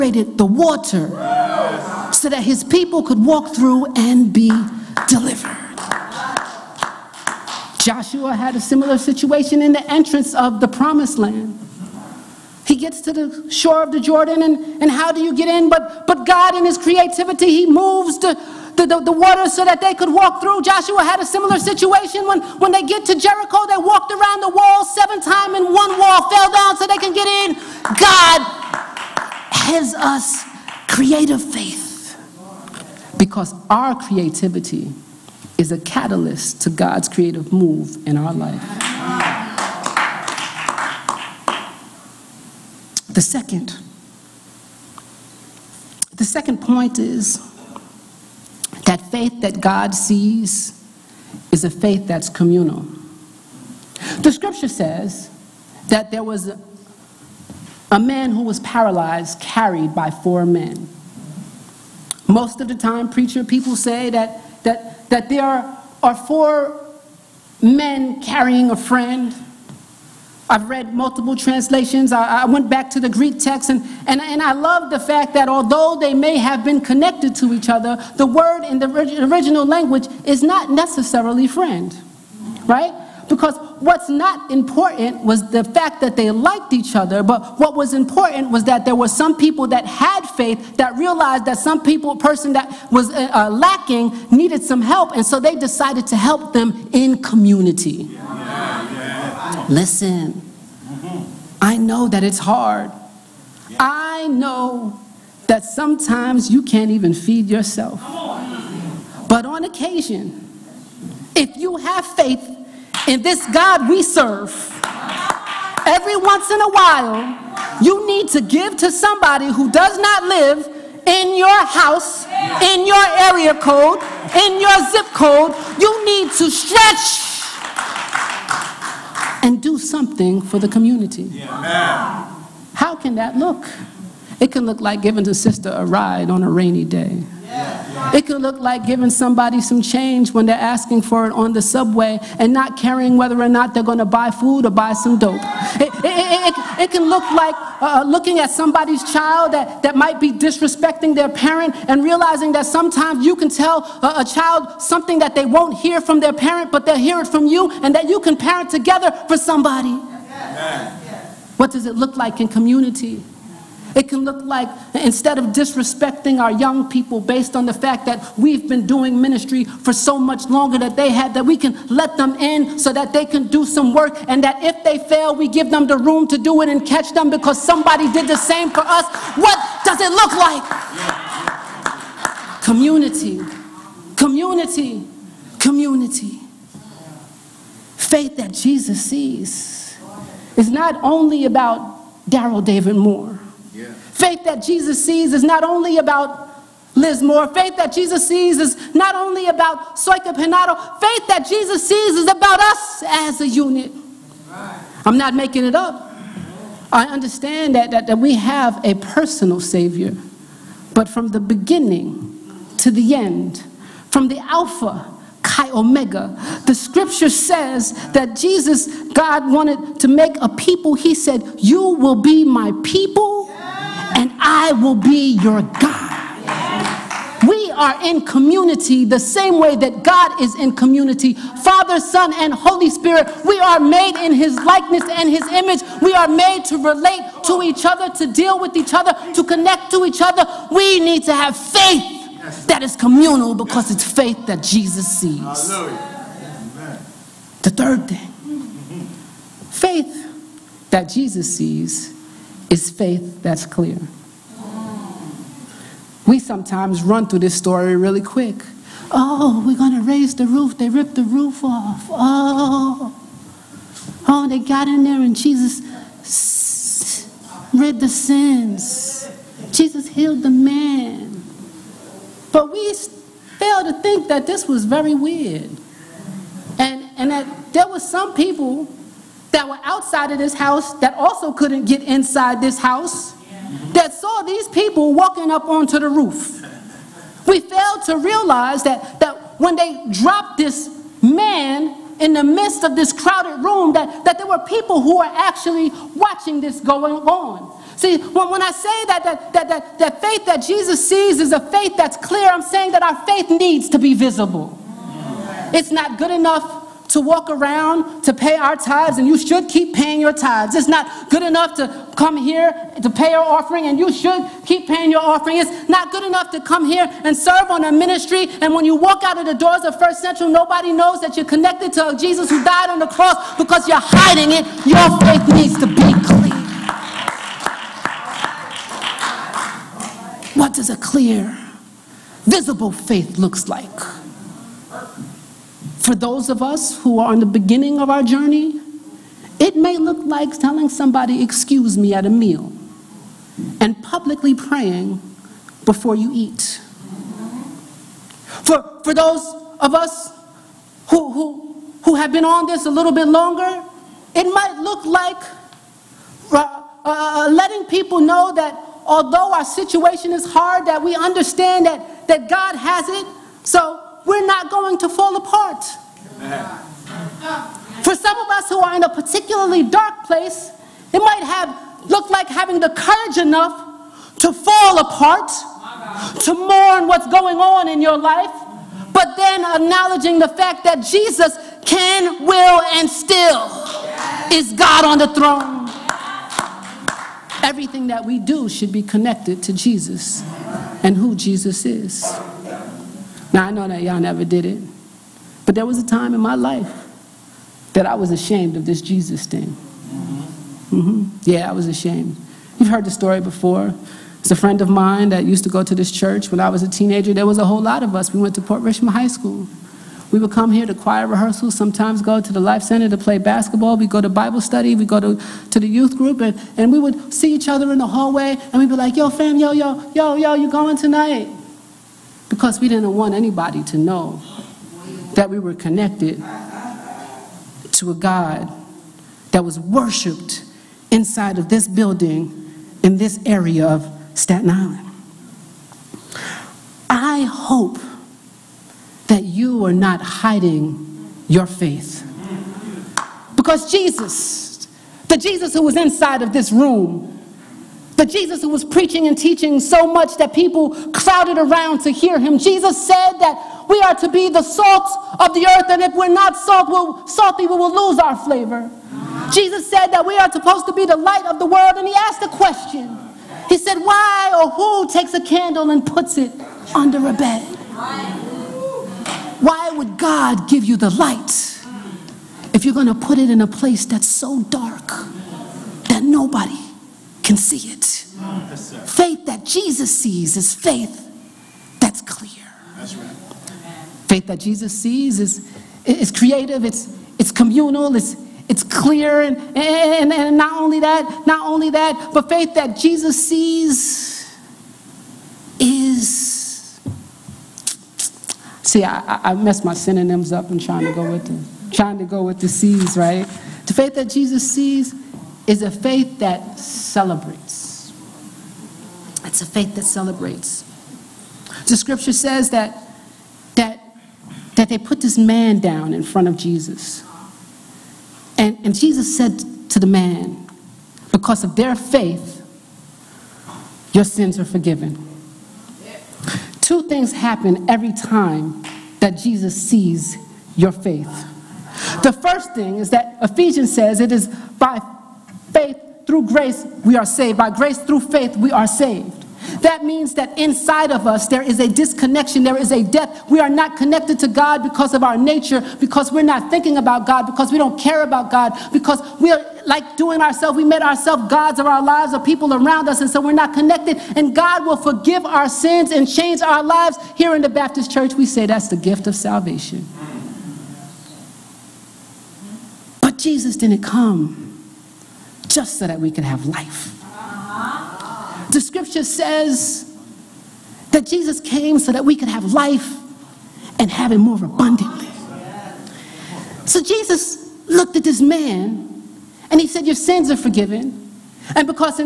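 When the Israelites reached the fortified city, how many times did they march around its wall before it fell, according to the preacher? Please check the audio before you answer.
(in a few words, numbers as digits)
7.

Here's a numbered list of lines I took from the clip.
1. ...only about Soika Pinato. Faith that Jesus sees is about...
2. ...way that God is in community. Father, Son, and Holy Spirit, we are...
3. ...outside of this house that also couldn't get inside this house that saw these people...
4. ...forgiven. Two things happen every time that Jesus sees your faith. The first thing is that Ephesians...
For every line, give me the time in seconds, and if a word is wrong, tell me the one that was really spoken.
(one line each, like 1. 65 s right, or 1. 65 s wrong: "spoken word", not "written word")
1. 199 s right
2. 229 s right
3. 279 s right
4. 524 s right.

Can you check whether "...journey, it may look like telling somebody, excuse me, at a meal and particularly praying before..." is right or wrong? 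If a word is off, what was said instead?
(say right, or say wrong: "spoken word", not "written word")
wrong: "publicly", not "particularly".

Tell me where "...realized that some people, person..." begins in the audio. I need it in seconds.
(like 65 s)
90 s.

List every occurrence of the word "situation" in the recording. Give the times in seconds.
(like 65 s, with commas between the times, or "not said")
8 s, 21 s, 359 s.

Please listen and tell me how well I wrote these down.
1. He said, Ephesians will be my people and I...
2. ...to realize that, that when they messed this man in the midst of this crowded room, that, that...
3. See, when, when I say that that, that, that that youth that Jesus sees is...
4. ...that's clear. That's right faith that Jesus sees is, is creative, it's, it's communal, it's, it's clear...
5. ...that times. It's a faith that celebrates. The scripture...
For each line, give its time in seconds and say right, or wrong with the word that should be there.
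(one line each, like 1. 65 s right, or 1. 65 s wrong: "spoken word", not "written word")
1. 220 s wrong: "You", not "Ephesians"
2. 288 s wrong: "dropped", not "messed"
3. 297 s wrong: "faith", not "youth"
4. 481 s right
5. 506 s wrong: "celebrates", not "times".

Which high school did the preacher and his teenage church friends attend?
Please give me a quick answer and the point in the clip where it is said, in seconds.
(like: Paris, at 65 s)
Port Richmond High School, at 408 s.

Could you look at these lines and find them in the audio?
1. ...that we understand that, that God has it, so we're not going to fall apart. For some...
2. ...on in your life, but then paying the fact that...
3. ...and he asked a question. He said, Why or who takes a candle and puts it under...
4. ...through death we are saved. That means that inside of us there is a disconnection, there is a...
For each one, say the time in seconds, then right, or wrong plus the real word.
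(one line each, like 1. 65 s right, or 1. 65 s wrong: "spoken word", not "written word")
1. 360 s right
2. 377 s wrong: "acknowledging", not "paying"
3. 461 s right
4. 537 s wrong: "faith", not "death".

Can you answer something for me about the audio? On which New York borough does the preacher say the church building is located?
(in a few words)
Staten Island.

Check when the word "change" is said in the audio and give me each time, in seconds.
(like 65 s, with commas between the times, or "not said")
139 s, 556 s.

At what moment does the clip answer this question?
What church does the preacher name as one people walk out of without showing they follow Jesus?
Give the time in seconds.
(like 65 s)
319 s.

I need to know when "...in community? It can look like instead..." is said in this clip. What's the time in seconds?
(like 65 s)
162 s.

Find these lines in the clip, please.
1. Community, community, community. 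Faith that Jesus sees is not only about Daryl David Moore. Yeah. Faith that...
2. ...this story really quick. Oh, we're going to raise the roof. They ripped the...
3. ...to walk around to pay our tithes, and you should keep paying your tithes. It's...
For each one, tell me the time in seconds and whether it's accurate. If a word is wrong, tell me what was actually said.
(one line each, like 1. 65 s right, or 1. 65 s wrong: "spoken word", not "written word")
1. 182 s right
2. 257 s right
3. 307 s right.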